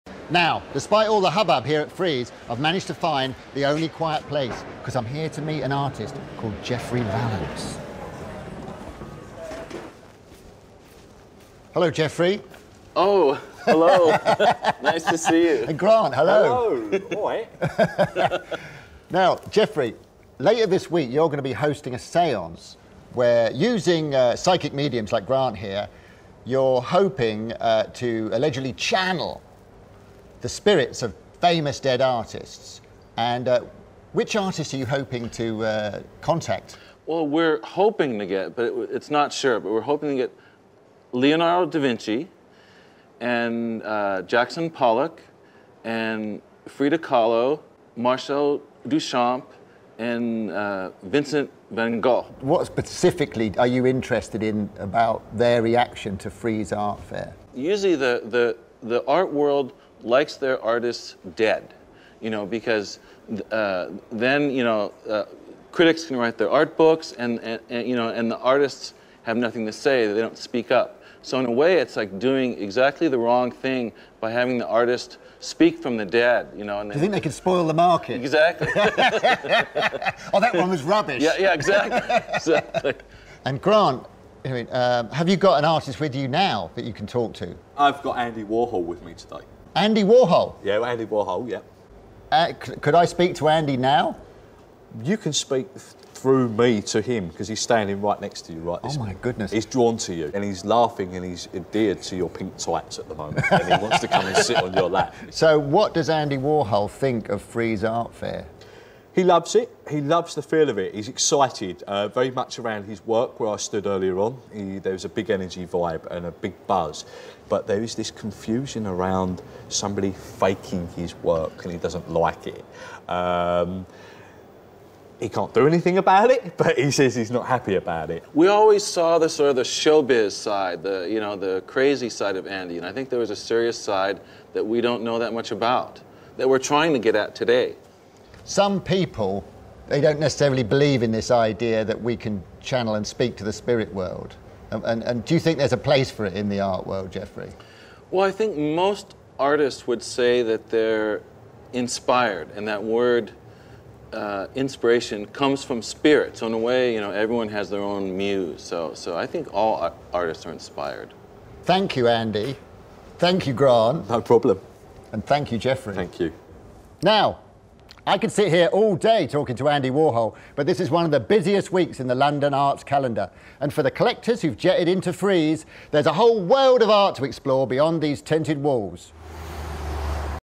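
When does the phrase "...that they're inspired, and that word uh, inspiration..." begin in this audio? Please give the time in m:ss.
2:30.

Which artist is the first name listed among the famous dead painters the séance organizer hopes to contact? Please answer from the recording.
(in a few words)
Leonardo da Vinci.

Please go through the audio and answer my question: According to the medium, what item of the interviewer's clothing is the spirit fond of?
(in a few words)
pink tights.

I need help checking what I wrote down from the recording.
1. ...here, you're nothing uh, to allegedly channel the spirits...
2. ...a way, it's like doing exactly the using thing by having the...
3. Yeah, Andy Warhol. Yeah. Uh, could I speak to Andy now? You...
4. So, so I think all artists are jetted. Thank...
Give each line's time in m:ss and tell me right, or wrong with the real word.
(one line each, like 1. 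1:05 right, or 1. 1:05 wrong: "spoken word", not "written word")
1. 0:25 wrong: "hoping", not "nothing"
2. 1:11 wrong: "wrong", not "using"
3. 1:30 right
4. 2:38 wrong: "inspired", not "jetted".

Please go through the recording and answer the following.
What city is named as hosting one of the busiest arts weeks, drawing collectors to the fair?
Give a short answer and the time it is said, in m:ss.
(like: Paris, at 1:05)
London, at 2:52.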